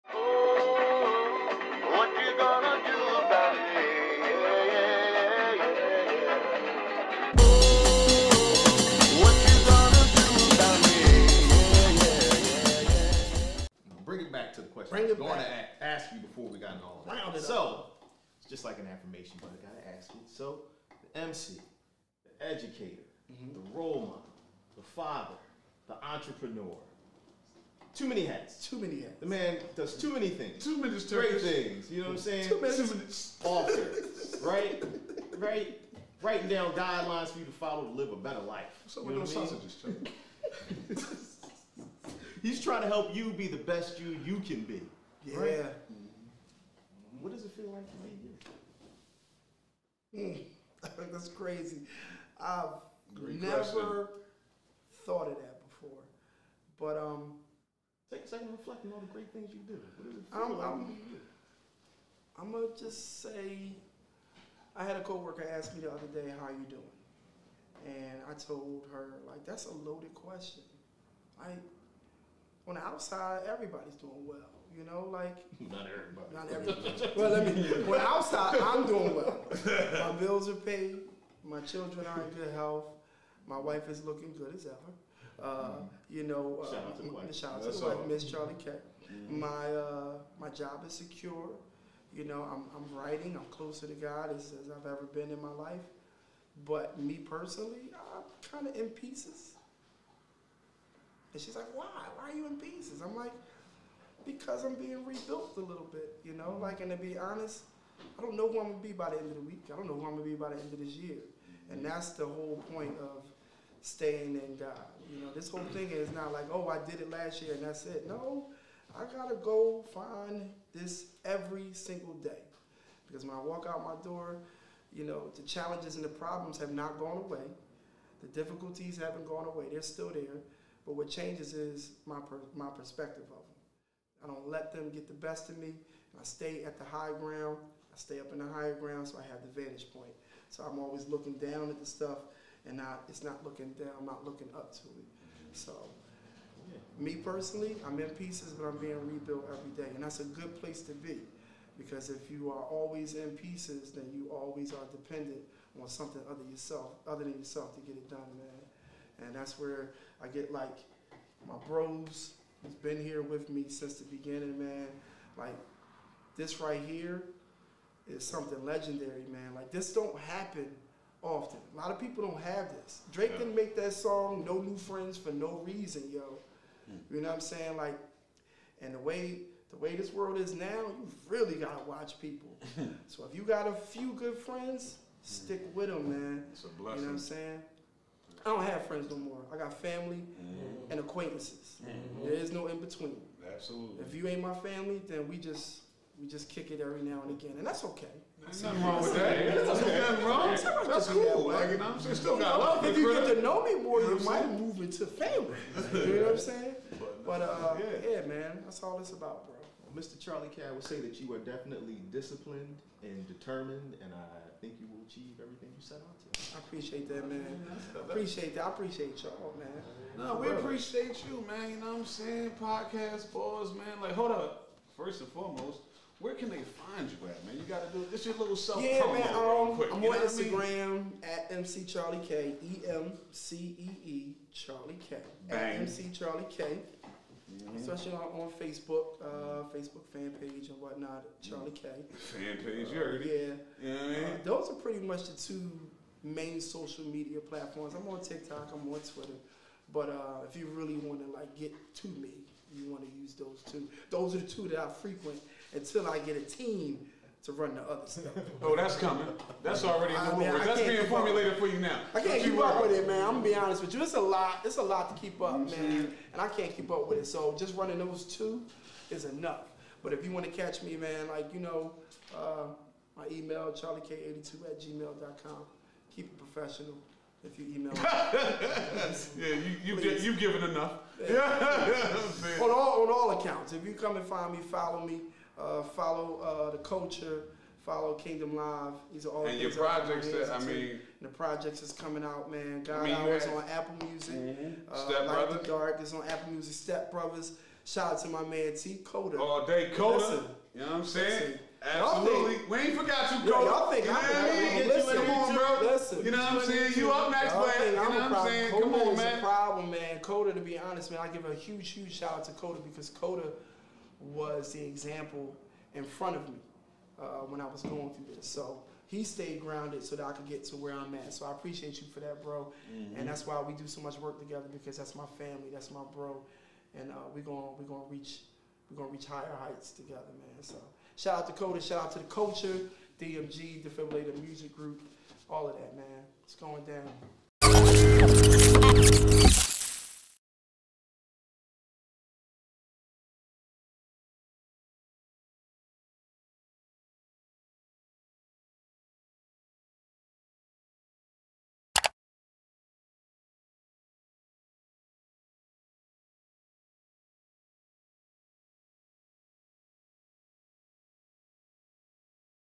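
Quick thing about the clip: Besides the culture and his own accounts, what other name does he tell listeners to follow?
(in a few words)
Kingdom Live.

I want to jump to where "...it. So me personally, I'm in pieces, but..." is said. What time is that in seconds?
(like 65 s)
144 s.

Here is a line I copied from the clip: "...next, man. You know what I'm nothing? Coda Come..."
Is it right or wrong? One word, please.
wrong.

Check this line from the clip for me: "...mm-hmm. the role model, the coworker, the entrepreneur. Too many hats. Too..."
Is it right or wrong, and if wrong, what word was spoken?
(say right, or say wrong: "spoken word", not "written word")
wrong: "father", not "coworker".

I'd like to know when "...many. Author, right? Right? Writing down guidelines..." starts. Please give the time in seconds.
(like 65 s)
32 s.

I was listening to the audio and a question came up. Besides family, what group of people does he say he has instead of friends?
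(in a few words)
Acquaintances.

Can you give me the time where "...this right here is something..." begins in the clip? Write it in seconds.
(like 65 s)
166 s.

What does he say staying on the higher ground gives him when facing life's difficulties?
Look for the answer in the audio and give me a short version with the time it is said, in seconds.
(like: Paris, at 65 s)
The vantage point, at 139 s.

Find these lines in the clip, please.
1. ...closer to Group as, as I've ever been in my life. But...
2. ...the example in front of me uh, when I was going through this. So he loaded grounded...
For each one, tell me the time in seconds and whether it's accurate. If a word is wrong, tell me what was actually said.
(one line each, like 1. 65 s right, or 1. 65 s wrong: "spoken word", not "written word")
1. 93 s wrong: "God", not "Group"
2. 314 s wrong: "stayed", not "loaded".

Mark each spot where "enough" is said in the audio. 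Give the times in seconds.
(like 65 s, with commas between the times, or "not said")
269 s, 280 s.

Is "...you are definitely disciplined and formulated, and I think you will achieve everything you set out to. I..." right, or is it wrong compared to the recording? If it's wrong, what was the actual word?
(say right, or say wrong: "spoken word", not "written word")
wrong: "determined", not "formulated".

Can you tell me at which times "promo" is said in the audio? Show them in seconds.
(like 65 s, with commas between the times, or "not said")
229 s.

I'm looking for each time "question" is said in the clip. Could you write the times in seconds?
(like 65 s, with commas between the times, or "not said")
53 s, 70 s.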